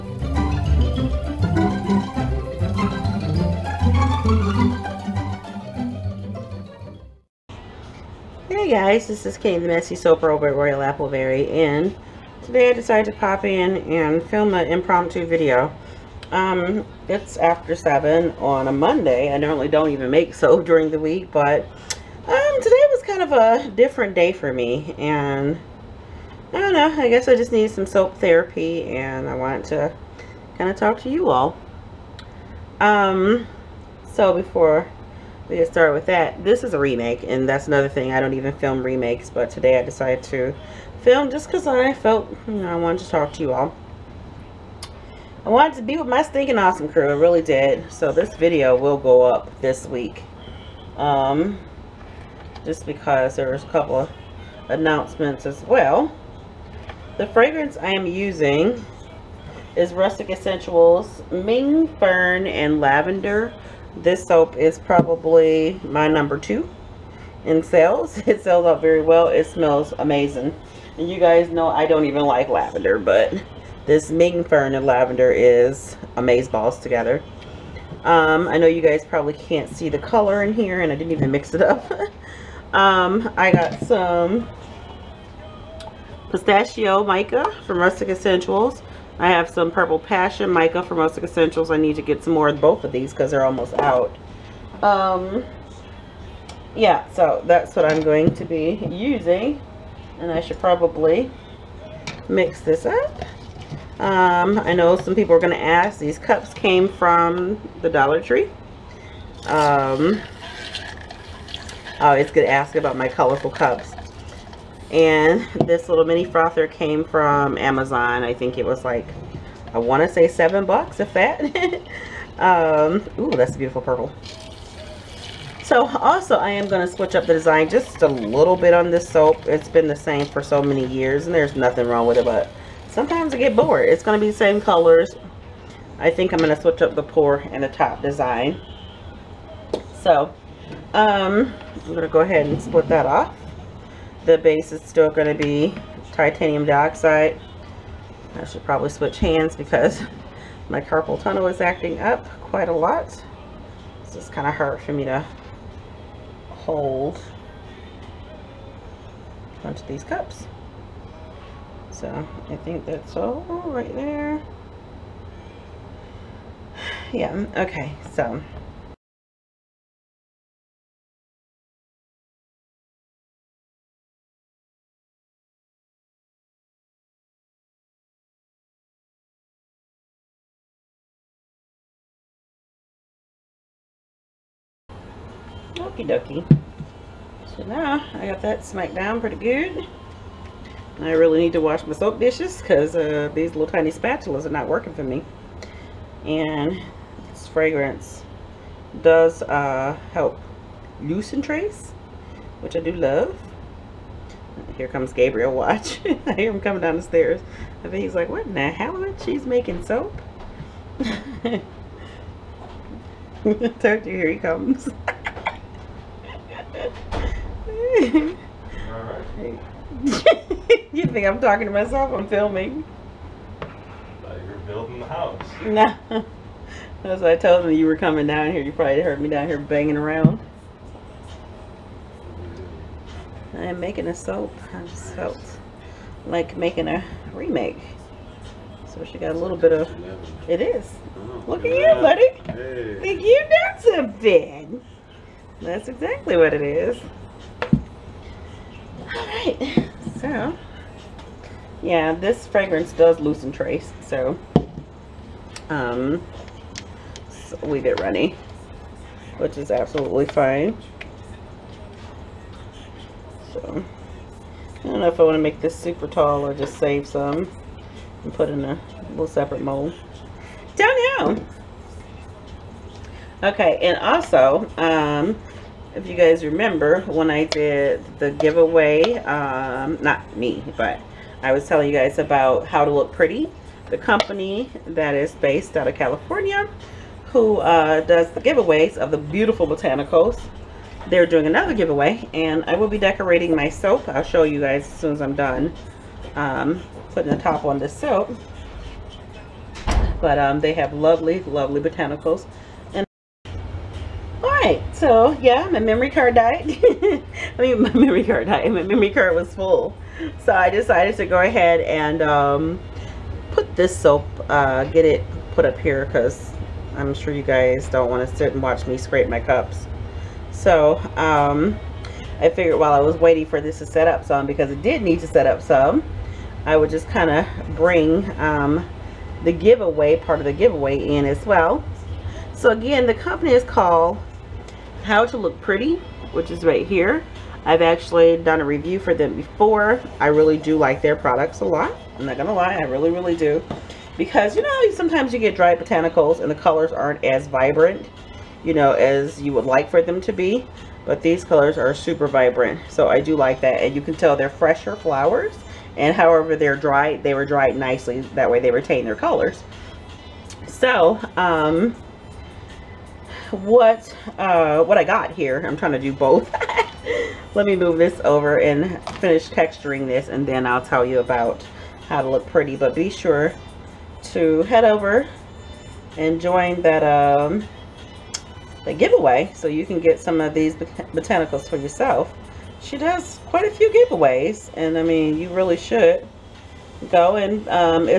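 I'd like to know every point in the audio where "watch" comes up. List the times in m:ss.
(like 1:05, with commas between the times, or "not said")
3:25, 5:18.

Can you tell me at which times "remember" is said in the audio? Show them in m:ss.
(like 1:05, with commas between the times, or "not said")
4:36.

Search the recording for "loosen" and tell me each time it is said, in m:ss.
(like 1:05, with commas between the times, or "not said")
3:21, 4:13.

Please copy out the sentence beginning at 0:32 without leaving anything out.
Um, so before we get started with that, this is a remake and that's another thing.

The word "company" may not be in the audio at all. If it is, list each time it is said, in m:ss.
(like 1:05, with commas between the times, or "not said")
4:43, 5:33.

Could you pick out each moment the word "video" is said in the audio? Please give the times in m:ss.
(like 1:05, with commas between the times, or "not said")
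0:15, 0:48.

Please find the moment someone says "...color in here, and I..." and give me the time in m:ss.
1:19.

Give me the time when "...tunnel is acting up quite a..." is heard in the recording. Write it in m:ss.
2:31.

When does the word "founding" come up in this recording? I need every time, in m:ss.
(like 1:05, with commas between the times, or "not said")
not said.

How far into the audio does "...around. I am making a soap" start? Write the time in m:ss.
3:49.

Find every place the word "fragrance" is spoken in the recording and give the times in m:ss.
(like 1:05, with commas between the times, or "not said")
0:57, 3:17, 4:12.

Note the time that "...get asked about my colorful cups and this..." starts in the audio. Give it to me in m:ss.
1:52.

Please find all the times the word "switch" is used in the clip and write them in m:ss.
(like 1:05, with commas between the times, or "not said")
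2:06, 2:16, 2:28.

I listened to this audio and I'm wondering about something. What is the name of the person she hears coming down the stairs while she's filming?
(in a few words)
Gabriel.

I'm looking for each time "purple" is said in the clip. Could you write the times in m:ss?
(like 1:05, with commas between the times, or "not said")
1:29, 2:03.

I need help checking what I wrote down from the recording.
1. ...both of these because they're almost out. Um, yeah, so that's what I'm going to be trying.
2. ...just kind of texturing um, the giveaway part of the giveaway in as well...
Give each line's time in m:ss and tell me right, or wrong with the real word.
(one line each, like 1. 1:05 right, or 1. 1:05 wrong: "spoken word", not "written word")
1. 1:32 wrong: "using", not "trying"
2. 5:26 wrong: "bring", not "texturing".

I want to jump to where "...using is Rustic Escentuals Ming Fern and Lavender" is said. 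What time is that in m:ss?
0:58.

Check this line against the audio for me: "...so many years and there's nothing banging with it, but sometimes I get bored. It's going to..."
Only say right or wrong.
wrong.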